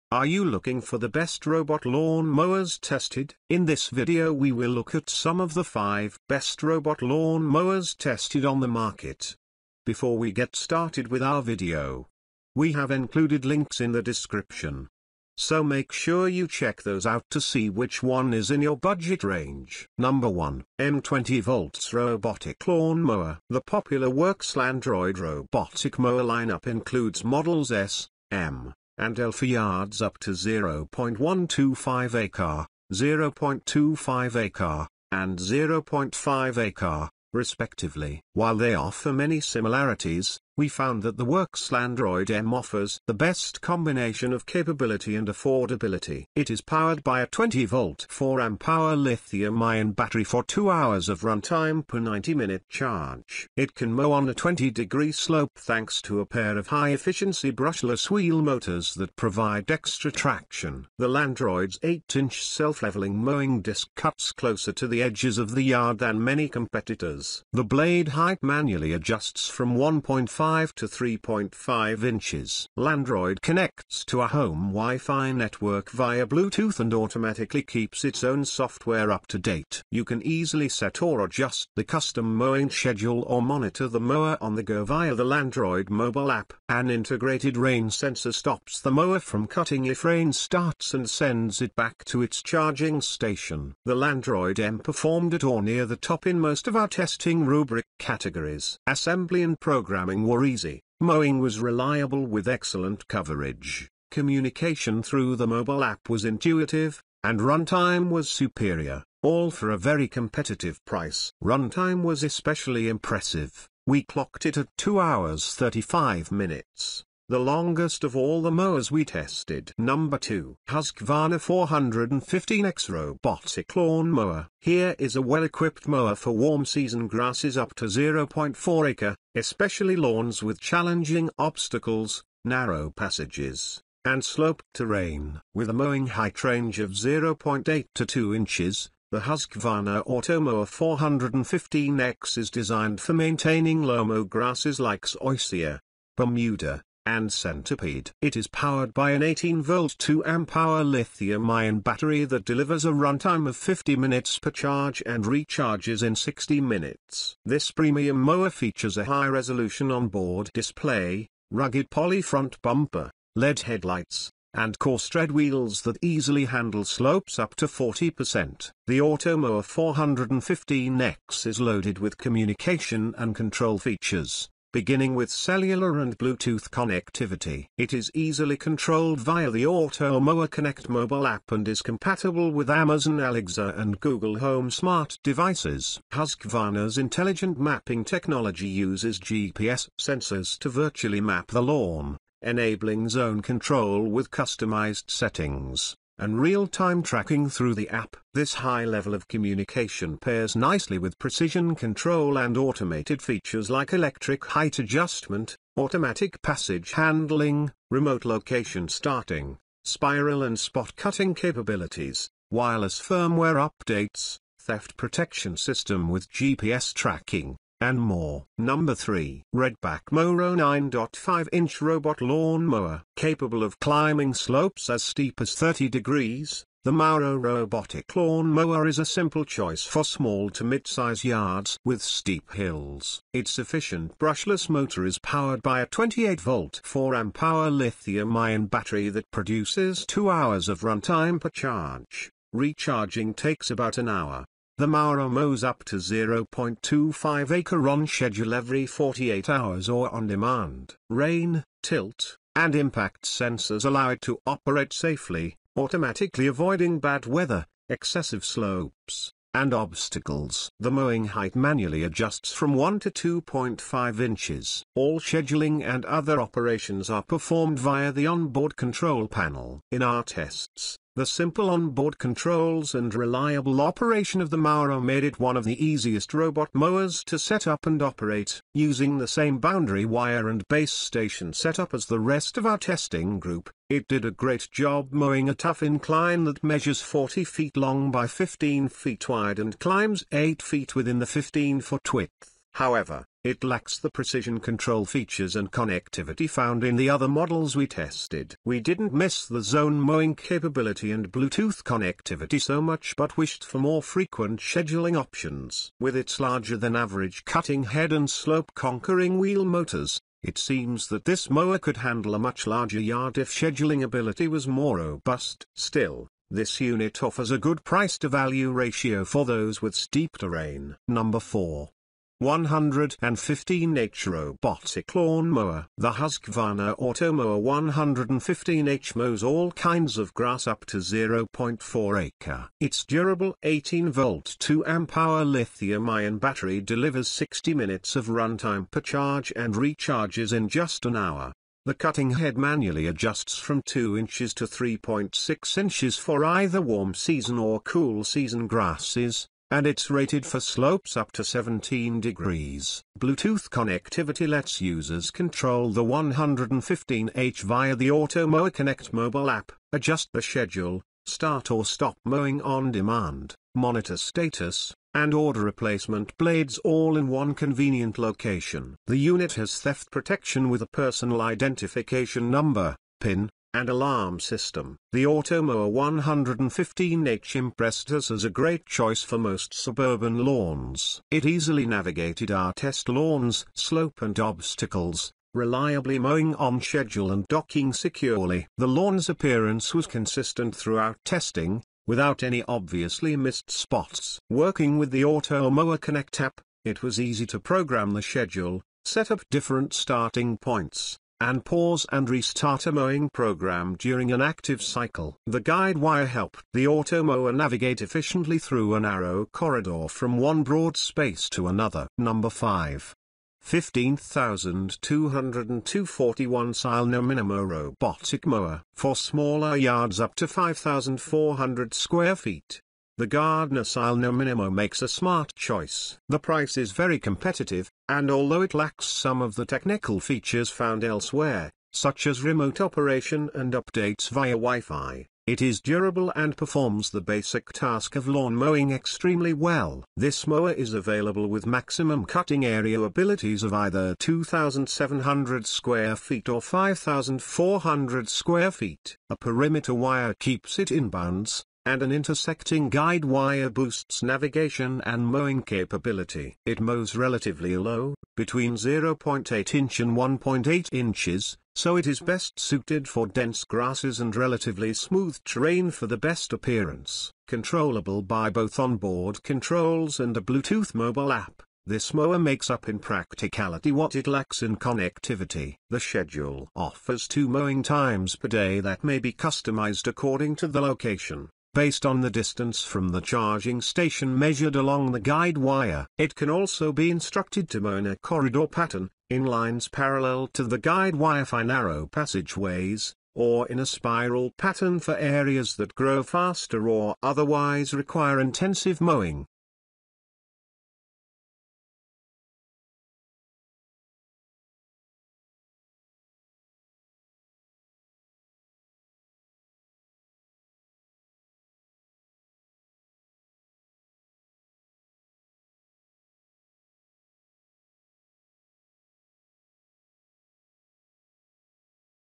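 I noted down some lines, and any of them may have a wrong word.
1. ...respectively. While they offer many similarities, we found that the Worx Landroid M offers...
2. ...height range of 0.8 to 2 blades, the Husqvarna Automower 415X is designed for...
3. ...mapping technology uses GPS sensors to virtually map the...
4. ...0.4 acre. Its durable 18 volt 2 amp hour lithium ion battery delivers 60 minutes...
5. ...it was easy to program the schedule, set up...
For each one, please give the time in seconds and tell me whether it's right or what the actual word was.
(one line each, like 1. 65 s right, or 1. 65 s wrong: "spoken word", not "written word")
1. 37 s right
2. 136 s wrong: "inches", not "blades"
3. 187 s right
4. 330 s right
5. 396 s right.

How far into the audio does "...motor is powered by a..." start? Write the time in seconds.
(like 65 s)
234 s.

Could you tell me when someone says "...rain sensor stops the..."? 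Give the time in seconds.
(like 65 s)
87 s.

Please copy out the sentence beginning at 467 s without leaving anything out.
Controllable by both onboard controls and a Bluetooth mobile app, this mower makes up in practicality what it lacks in connectivity.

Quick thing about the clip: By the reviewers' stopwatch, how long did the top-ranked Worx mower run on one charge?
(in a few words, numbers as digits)
2 hours 35 minutes.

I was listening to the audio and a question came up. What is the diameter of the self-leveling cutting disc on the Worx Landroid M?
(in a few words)
8-inch.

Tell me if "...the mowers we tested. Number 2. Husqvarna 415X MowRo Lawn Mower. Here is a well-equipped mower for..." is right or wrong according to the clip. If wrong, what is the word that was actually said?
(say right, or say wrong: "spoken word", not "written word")
wrong: "Robotic", not "MowRo".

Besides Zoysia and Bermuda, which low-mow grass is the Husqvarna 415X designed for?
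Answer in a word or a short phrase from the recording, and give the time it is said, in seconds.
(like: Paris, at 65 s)
Centipede, at 147 s.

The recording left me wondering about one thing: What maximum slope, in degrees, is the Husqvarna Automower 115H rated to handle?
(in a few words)
17 degrees.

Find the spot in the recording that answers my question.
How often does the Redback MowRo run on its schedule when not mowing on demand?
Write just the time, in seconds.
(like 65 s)
248 s.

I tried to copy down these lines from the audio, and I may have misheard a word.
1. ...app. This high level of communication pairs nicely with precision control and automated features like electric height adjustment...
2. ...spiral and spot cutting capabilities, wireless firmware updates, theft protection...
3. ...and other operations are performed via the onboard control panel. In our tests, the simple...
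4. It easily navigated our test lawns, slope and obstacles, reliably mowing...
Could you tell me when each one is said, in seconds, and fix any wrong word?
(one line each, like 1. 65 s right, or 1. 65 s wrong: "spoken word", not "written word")
1. 197 s right
2. 209 s right
3. 265 s right
4. 381 s right.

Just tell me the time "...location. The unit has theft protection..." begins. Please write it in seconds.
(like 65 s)
368 s.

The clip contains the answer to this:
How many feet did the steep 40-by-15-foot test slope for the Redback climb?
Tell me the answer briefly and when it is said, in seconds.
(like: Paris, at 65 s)
8 feet, at 290 s.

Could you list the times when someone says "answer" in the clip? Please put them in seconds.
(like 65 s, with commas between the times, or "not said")
not said.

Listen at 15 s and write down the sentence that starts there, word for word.
So make sure you check those out to see which one is in your budget range.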